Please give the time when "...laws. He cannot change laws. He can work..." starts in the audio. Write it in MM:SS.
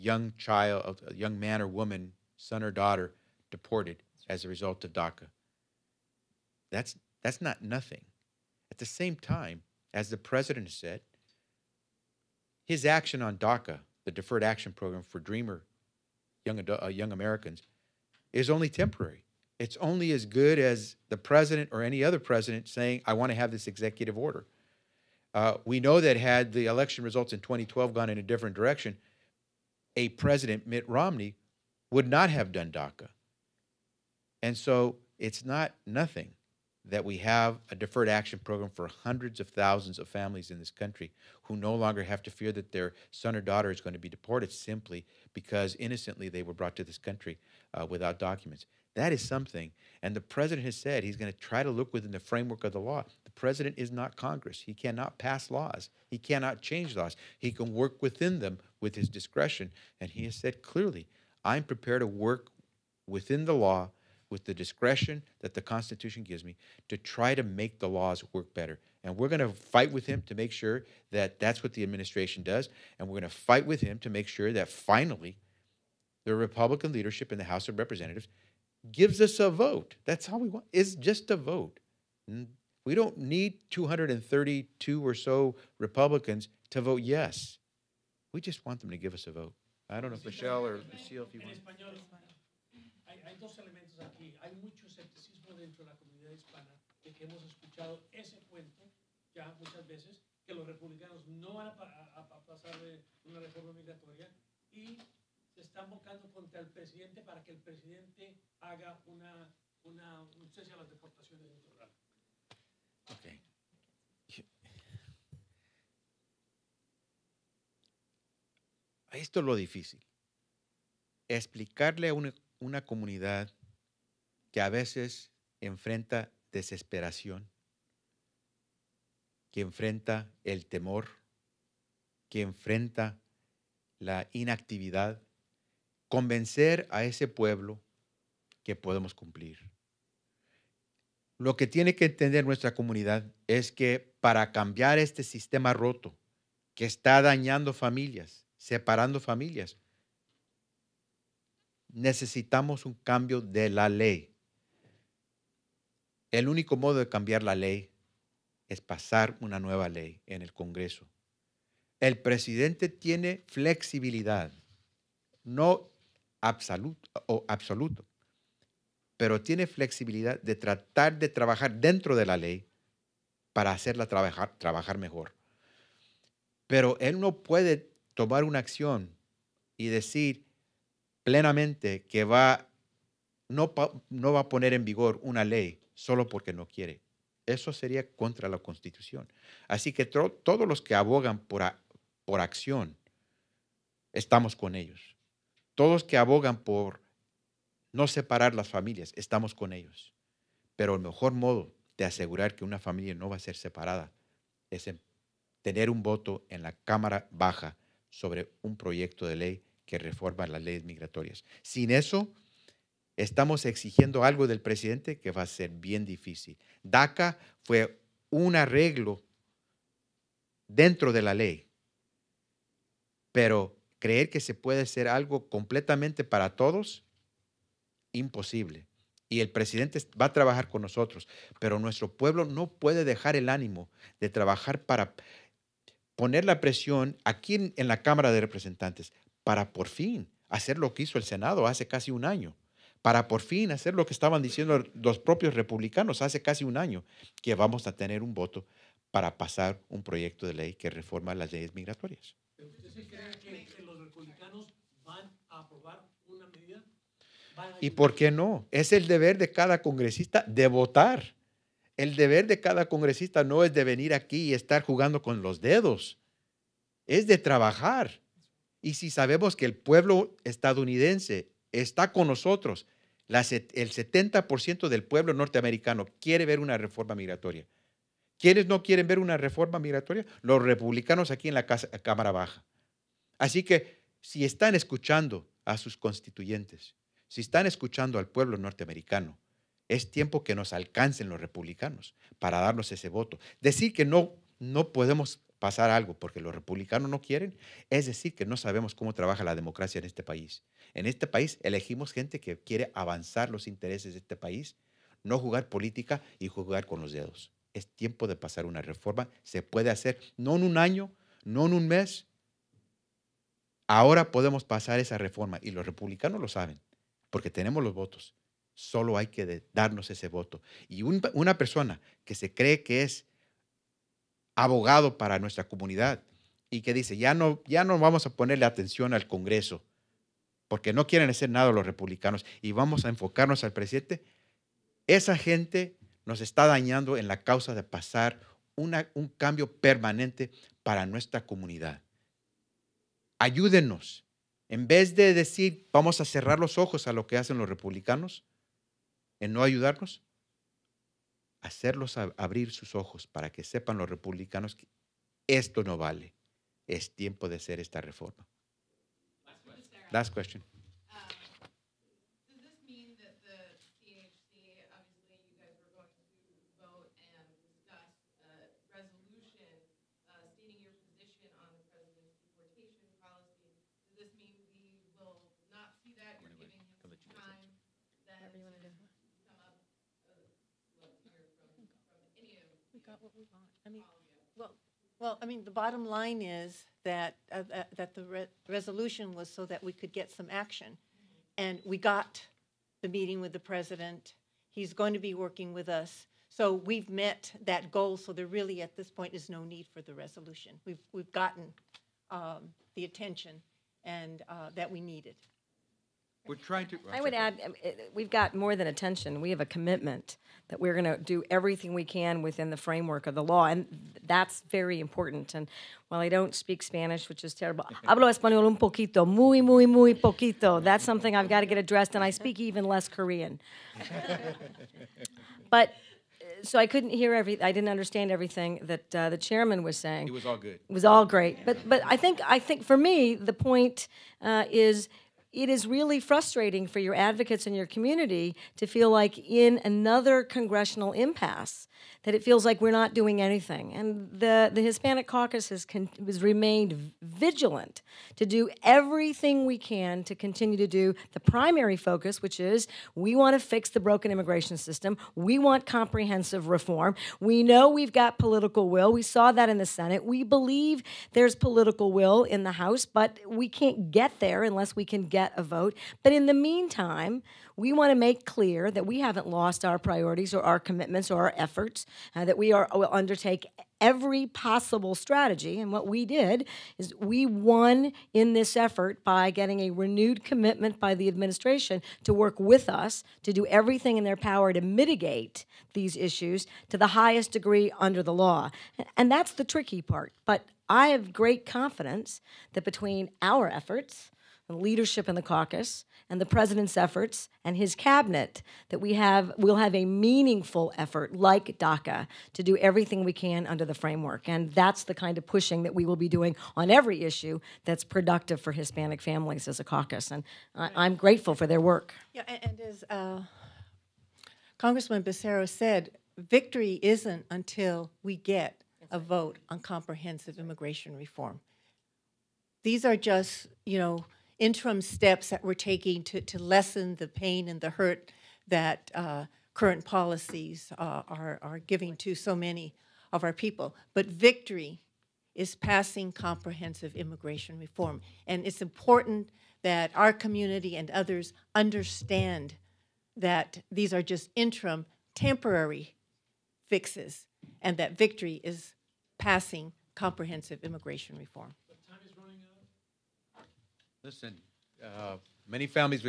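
00:55.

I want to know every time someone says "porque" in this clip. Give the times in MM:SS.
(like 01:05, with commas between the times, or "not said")
03:06, 04:56, 05:17, 05:30.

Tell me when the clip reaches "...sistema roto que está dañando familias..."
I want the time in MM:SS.
02:25.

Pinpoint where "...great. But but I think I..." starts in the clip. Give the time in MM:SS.
07:11.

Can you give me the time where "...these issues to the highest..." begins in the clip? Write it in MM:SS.
08:05.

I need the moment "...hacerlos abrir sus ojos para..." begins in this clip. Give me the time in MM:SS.
05:51.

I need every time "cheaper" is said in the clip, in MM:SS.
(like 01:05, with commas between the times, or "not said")
not said.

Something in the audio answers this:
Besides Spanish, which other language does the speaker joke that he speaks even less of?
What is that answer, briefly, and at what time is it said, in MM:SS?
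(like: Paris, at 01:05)
Korean, at 07:03.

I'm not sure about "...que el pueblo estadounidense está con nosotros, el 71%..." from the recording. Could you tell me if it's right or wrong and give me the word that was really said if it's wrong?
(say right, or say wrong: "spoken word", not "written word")
wrong: "70", not "71".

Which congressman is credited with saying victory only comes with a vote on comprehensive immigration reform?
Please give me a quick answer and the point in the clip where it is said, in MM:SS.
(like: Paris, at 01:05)
Becerra, at 08:35.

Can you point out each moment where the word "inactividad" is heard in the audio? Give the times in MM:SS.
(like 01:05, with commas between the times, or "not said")
02:14.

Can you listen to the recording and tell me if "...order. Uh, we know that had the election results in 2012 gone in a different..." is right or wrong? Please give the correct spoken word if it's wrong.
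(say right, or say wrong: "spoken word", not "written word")
right.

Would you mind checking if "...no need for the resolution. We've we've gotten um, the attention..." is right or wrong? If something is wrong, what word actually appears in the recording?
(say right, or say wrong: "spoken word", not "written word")
right.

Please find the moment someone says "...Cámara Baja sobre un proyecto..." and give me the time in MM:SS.
03:26.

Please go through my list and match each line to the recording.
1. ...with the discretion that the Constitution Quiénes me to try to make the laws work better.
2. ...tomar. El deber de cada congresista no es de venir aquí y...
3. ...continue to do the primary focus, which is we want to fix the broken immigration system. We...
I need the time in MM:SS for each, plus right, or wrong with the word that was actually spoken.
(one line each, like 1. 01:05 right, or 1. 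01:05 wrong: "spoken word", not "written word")
1. 01:04 wrong: "gives", not "Quiénes"
2. 04:20 wrong: "votar", not "tomar"
3. 07:30 right.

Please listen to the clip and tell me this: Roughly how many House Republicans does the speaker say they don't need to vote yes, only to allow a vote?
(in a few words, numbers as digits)
232.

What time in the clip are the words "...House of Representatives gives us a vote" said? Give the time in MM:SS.
01:17.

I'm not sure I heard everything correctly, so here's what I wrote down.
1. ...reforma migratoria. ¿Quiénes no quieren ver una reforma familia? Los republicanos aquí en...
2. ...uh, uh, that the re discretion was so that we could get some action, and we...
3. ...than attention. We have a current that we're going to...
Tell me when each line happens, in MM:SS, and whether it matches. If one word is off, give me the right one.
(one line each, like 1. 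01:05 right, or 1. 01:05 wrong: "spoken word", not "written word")
1. 04:36 wrong: "migratoria", not "familia"
2. 06:27 wrong: "resolution", not "discretion"
3. 06:48 wrong: "commitment", not "current".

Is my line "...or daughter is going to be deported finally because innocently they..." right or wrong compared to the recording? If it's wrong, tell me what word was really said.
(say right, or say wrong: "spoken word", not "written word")
wrong: "simply", not "finally".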